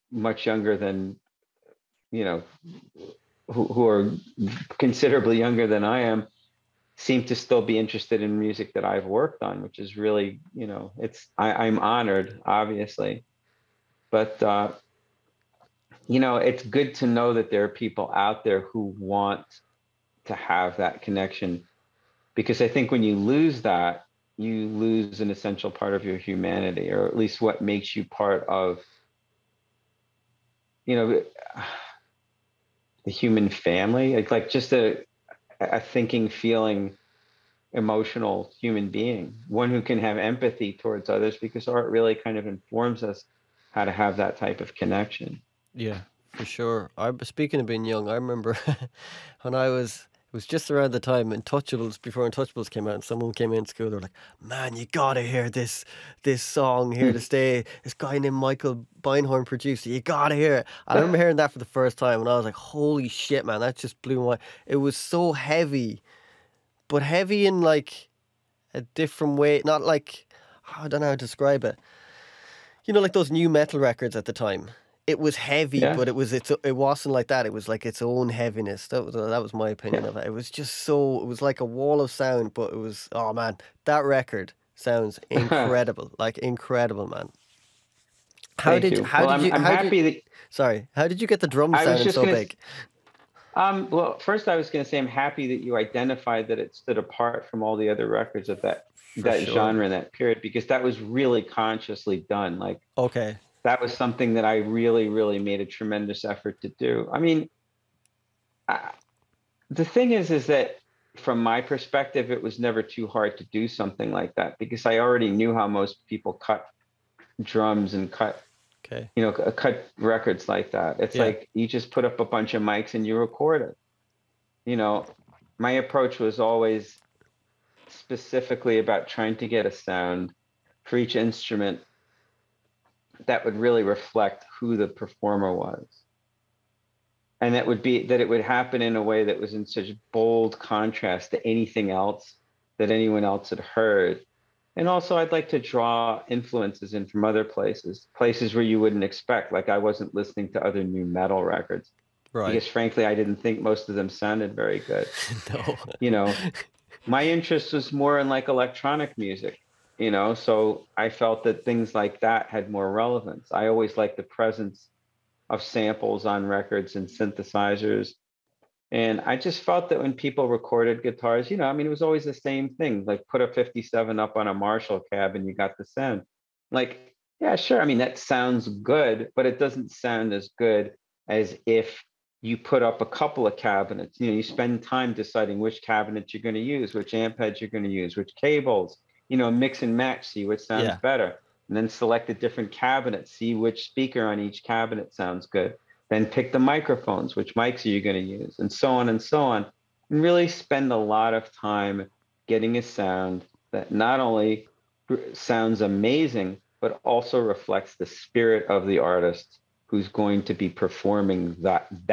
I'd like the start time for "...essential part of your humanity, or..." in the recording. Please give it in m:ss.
0:25.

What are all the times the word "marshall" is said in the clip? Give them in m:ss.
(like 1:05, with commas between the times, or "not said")
2:54.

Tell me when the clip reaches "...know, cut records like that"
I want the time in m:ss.
1:59.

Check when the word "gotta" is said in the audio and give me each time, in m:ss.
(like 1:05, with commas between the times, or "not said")
0:54, 1:00.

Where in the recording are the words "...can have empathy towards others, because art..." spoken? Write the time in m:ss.
0:39.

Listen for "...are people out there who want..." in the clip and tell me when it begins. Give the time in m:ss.
0:17.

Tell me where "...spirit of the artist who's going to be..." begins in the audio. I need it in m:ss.
3:28.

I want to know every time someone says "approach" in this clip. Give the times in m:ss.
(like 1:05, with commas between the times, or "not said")
2:05.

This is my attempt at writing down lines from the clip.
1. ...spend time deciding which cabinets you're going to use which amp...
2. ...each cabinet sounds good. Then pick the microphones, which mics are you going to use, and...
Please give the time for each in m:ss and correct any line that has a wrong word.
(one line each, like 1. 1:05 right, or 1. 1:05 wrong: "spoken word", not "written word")
1. 3:04 right
2. 3:14 right.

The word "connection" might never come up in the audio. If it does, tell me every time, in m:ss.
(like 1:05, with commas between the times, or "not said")
0:21, 0:44.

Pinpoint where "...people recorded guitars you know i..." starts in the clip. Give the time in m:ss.
2:50.